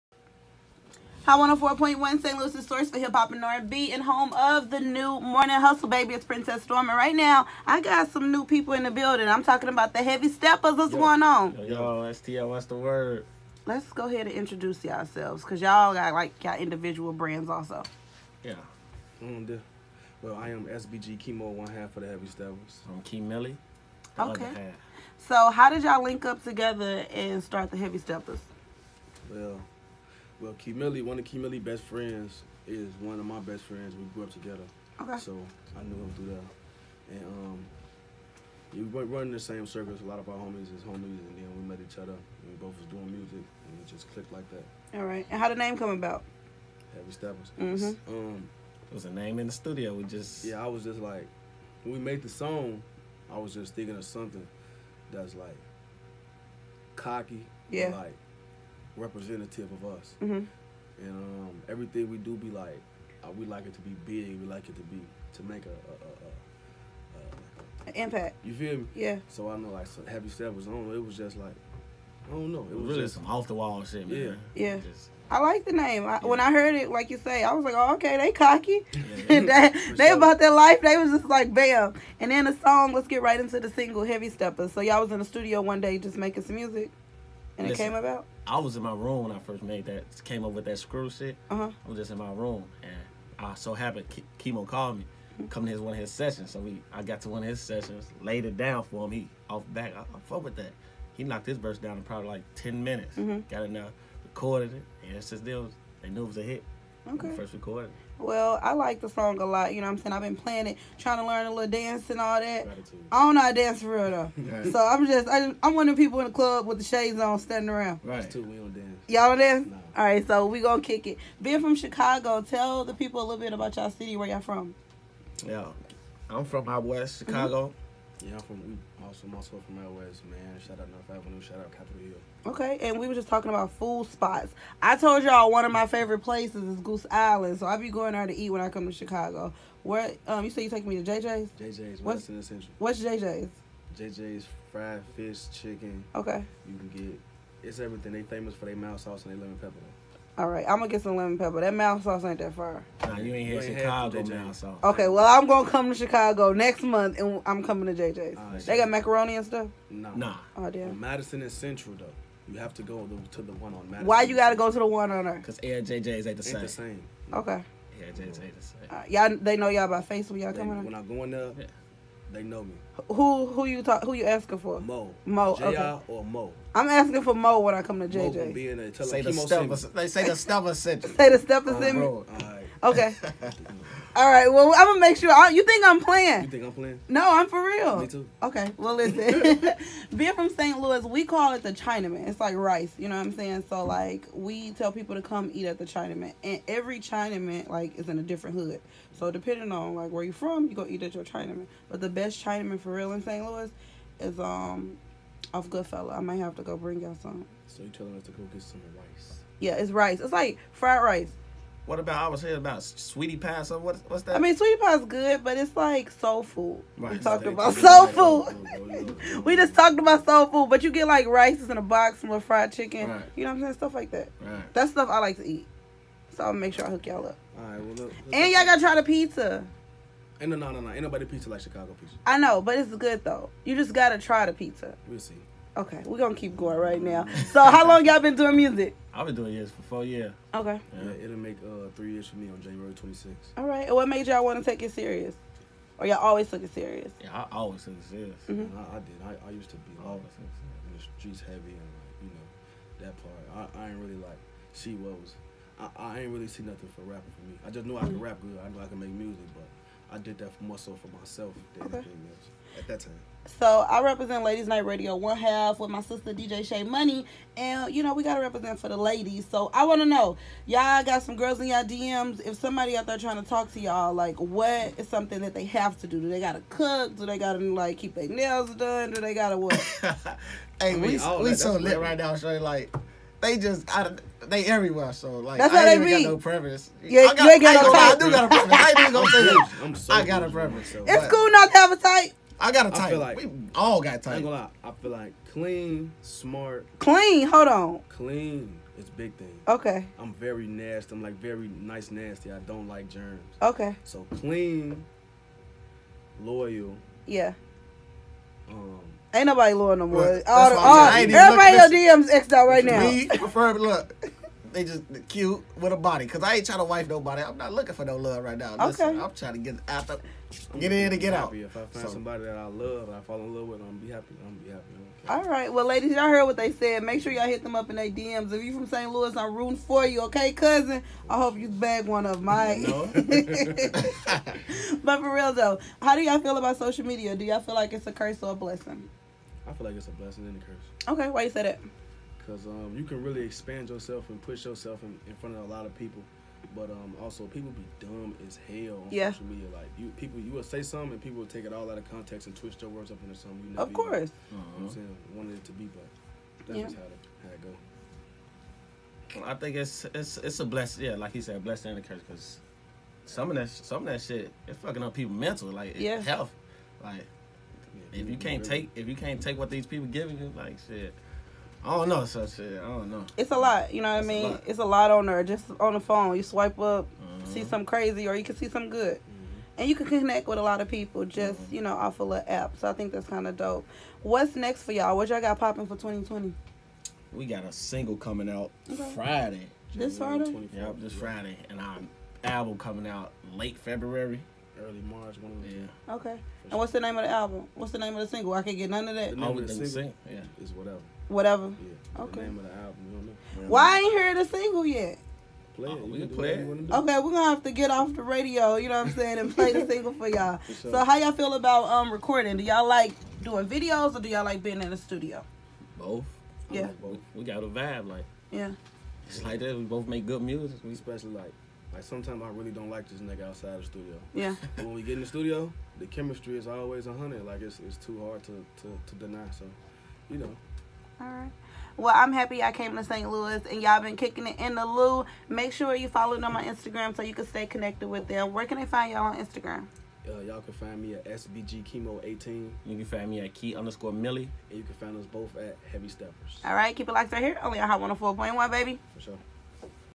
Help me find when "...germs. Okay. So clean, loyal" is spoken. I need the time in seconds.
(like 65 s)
303 s.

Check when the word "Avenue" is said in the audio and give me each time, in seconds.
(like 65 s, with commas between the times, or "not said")
131 s.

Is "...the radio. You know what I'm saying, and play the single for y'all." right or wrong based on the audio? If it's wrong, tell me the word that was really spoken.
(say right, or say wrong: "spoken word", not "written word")
right.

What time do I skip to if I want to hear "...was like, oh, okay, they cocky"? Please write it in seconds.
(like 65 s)
77 s.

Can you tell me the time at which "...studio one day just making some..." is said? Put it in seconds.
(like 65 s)
85 s.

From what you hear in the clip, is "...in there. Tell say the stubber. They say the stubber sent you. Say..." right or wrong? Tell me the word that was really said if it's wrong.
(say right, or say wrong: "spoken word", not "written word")
right.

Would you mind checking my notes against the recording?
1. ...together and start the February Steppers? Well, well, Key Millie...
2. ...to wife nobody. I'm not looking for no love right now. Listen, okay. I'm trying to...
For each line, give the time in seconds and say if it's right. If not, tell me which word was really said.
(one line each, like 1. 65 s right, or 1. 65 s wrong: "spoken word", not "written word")
1. 26 s wrong: "Heavy", not "February"
2. 316 s right.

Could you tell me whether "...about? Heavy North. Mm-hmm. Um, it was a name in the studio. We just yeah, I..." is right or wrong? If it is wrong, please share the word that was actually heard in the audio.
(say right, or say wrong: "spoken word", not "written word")
wrong: "Steppers", not "North".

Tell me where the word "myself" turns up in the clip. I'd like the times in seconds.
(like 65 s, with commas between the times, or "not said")
261 s.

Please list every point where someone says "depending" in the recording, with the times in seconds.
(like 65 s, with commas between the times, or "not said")
199 s.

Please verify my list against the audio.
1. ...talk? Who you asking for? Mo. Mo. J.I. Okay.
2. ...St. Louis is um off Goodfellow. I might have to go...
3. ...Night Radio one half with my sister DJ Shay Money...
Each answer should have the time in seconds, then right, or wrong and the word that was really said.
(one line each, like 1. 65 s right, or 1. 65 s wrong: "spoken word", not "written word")
1. 173 s right
2. 203 s right
3. 264 s right.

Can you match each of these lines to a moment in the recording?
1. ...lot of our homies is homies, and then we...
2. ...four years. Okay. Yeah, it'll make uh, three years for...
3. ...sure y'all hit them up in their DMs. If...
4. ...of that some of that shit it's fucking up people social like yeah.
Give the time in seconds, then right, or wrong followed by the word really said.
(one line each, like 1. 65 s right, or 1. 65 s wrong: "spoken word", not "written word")
1. 40 s right
2. 239 s right
3. 327 s right
4. 363 s wrong: "mental", not "social".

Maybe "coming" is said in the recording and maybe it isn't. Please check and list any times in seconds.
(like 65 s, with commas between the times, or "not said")
95 s, 157 s, 170 s, 388 s, 392 s.